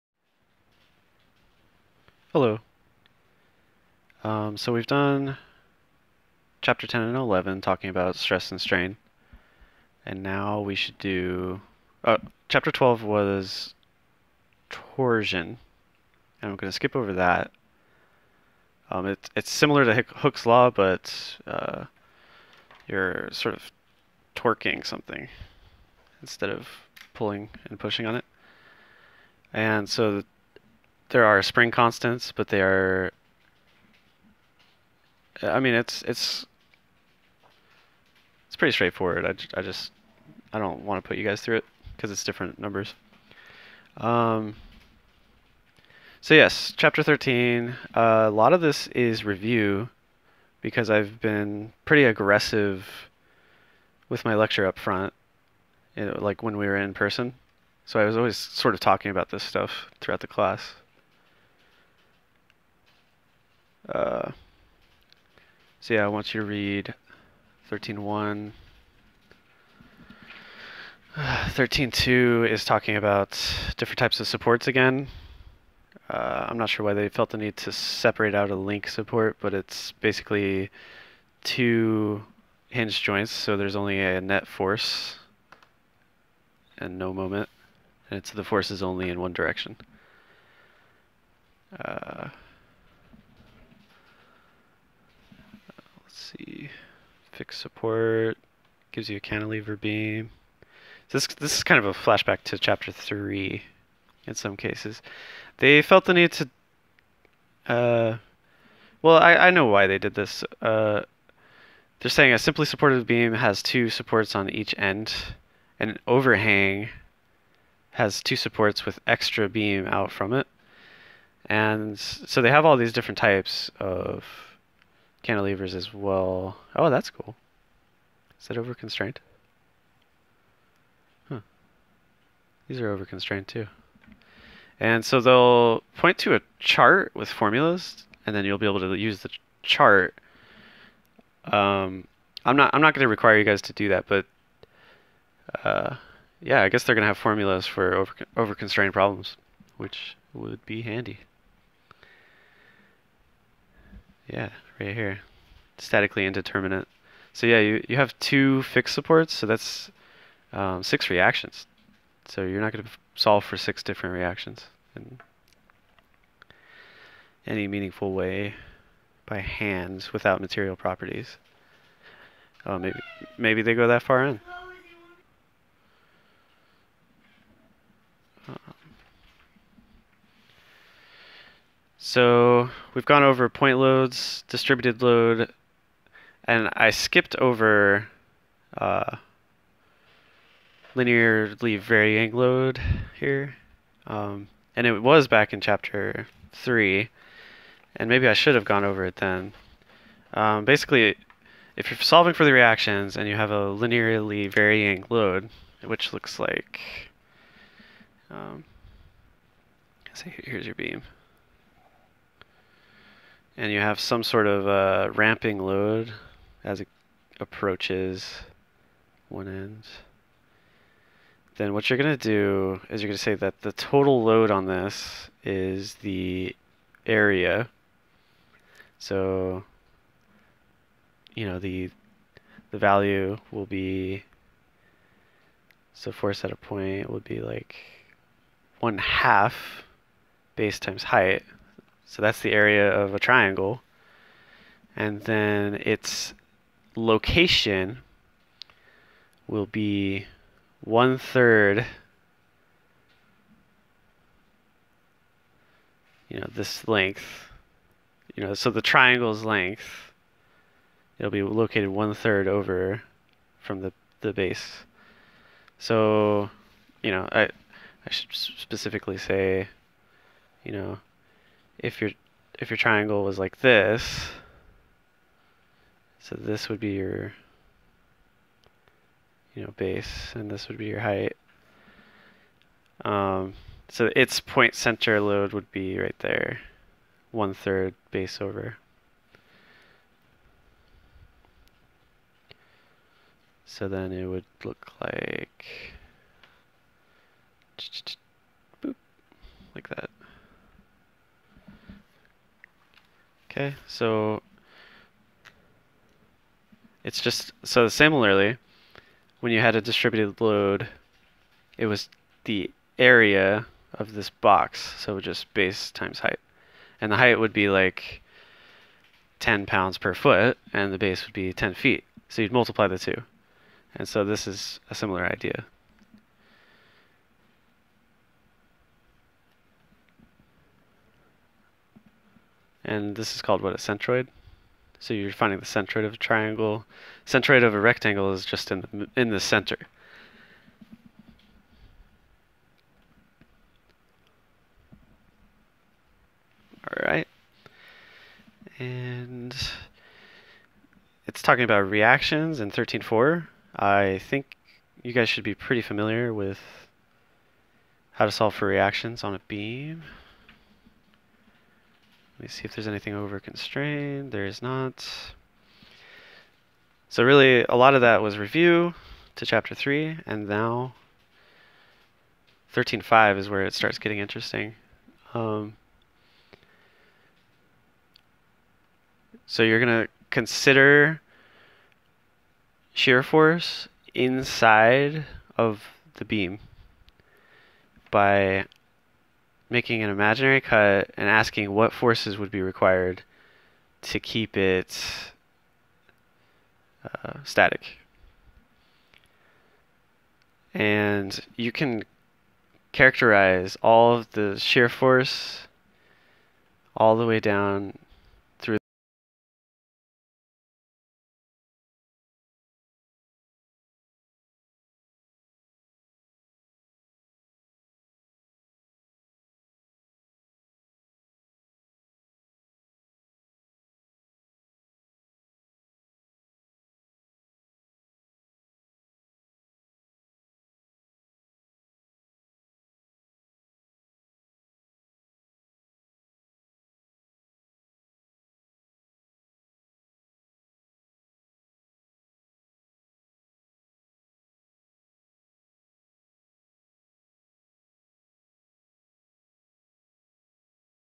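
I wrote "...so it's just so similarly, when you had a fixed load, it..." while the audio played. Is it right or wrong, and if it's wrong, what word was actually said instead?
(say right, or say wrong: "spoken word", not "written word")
wrong: "distributed", not "fixed".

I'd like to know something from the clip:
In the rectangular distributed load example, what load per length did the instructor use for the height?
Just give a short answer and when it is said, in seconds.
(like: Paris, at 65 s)
10 pounds per foot, at 319 s.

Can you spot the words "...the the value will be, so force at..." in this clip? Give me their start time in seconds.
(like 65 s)
231 s.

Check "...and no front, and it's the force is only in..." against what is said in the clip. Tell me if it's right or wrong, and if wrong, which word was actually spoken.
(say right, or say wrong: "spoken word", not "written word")
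wrong: "moment", not "front".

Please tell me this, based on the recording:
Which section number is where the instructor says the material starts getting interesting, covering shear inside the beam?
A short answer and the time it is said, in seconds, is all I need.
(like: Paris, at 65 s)
13.5, at 372 s.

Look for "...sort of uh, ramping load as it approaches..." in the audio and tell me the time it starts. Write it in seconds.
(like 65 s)
214 s.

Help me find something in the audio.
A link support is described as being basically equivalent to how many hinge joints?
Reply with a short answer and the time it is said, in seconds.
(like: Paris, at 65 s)
2, at 81 s.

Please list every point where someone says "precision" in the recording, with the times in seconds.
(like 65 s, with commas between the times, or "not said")
not said.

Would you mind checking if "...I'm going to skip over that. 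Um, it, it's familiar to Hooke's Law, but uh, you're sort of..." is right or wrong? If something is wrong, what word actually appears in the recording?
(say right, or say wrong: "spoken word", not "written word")
wrong: "similar", not "familiar".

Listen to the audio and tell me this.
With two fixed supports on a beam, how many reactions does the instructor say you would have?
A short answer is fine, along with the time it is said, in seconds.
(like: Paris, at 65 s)
6, at 160 s.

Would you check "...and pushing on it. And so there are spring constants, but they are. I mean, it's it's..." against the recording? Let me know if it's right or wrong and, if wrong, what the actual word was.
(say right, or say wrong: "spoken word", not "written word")
right.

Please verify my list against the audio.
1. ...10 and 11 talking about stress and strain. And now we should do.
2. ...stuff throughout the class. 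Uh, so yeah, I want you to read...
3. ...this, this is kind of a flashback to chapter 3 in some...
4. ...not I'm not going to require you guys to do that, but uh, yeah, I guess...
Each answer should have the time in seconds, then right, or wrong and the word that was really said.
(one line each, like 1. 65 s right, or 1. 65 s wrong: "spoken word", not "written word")
1. 6 s right
2. 59 s right
3. 101 s right
4. 142 s right.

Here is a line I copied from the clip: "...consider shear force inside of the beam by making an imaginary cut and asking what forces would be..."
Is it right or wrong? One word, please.
right.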